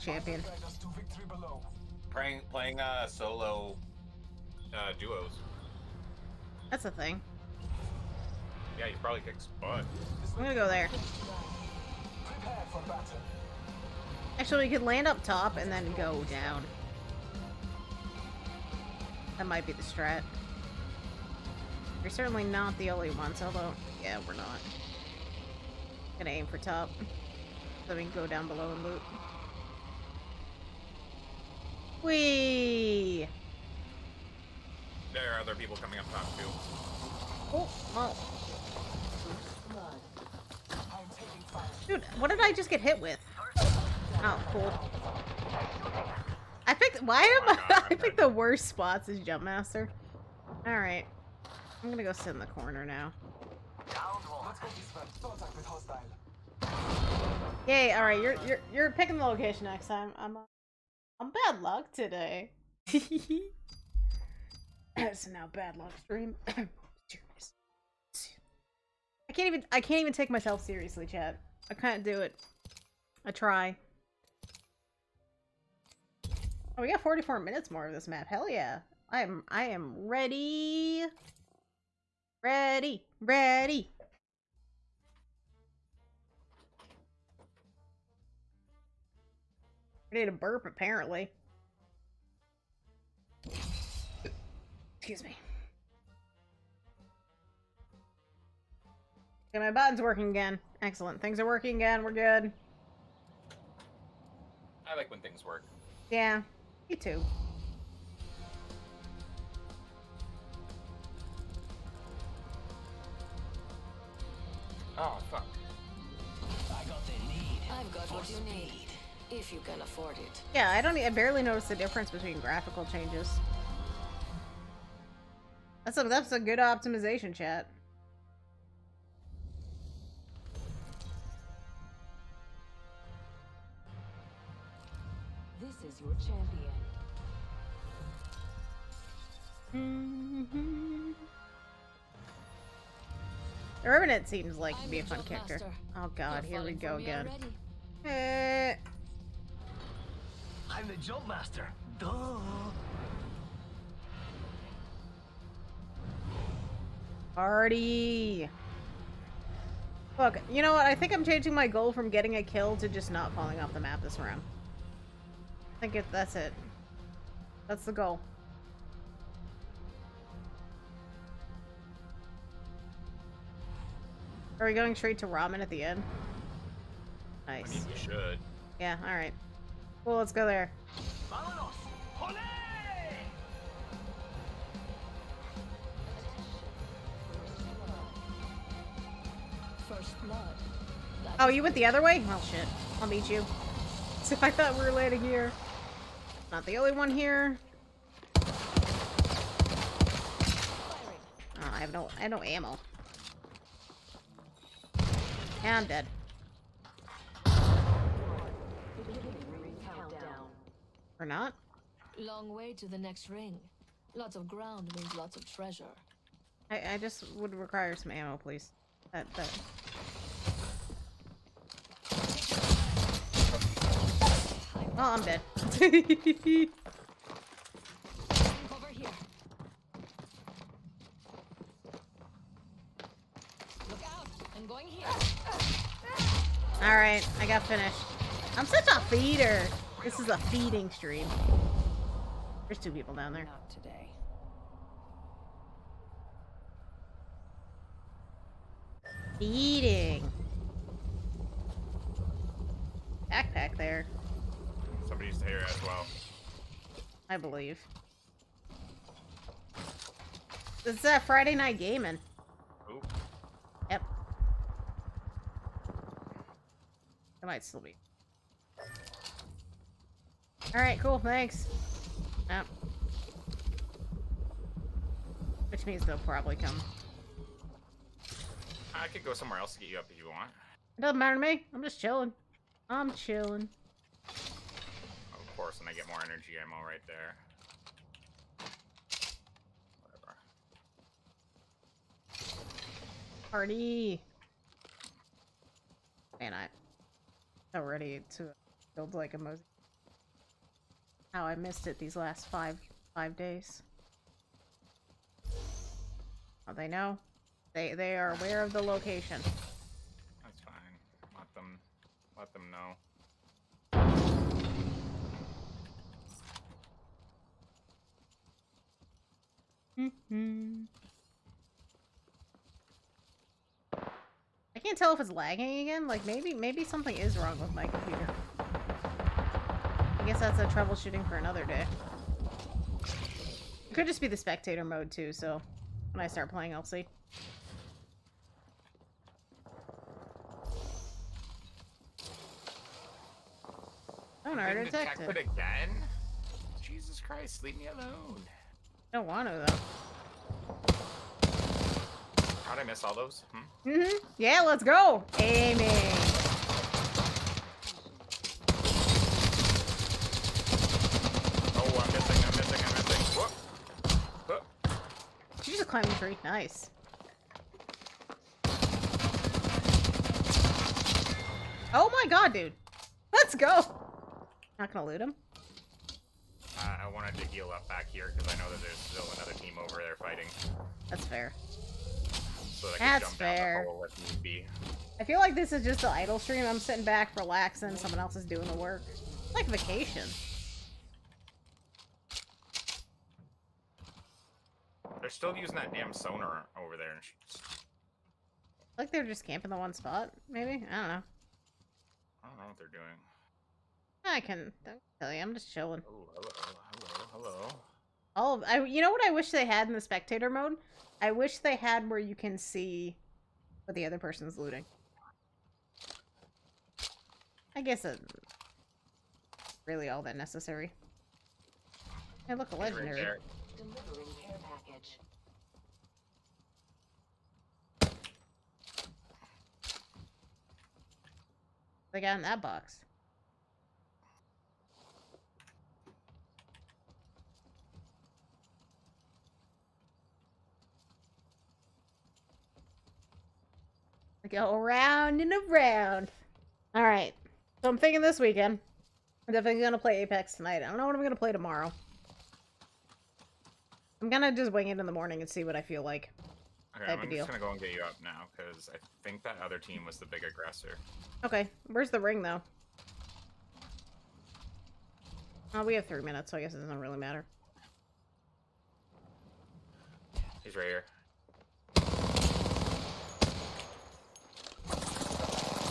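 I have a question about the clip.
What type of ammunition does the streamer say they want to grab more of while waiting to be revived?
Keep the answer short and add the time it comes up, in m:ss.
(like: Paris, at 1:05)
energy ammo, at 4:46.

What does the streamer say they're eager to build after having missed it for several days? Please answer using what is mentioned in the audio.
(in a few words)
a mosaic.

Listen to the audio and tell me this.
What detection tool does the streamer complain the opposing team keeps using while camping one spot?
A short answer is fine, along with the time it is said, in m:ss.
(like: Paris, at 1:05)
sonar, at 6:36.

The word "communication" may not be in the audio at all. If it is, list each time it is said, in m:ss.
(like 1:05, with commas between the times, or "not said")
not said.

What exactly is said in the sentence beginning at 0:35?
There are other people coming up top, too.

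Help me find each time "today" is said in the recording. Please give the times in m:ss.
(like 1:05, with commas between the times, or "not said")
1:01, 4:03.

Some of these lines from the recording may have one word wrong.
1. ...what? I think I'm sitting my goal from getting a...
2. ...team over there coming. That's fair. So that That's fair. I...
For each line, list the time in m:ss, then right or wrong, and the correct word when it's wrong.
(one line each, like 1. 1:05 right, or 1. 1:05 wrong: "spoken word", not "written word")
1. 2:40 wrong: "changing", not "sitting"
2. 6:19 wrong: "fighting", not "coming".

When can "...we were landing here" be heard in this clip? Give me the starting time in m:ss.
3:14.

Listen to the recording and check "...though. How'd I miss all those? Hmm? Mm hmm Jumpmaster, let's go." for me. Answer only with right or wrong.
wrong.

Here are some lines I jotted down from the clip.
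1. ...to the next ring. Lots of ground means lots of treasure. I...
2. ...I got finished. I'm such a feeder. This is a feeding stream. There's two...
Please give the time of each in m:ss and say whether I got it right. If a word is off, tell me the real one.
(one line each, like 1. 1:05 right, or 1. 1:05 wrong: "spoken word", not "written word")
1. 3:32 right
2. 3:57 right.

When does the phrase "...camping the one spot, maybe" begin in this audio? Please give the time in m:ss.
6:39.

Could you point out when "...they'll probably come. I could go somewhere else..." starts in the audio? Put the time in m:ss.
4:36.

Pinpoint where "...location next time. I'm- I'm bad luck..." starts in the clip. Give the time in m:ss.
0:59.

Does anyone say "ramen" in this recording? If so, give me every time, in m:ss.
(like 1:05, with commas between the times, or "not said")
2:55.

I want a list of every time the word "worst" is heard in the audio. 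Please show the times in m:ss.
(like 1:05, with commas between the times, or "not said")
0:48.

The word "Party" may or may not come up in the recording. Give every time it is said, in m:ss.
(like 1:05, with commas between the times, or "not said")
2:37, 4:53.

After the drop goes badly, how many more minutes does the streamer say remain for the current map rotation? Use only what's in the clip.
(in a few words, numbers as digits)
44.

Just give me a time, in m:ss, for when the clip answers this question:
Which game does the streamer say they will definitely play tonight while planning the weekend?
7:30.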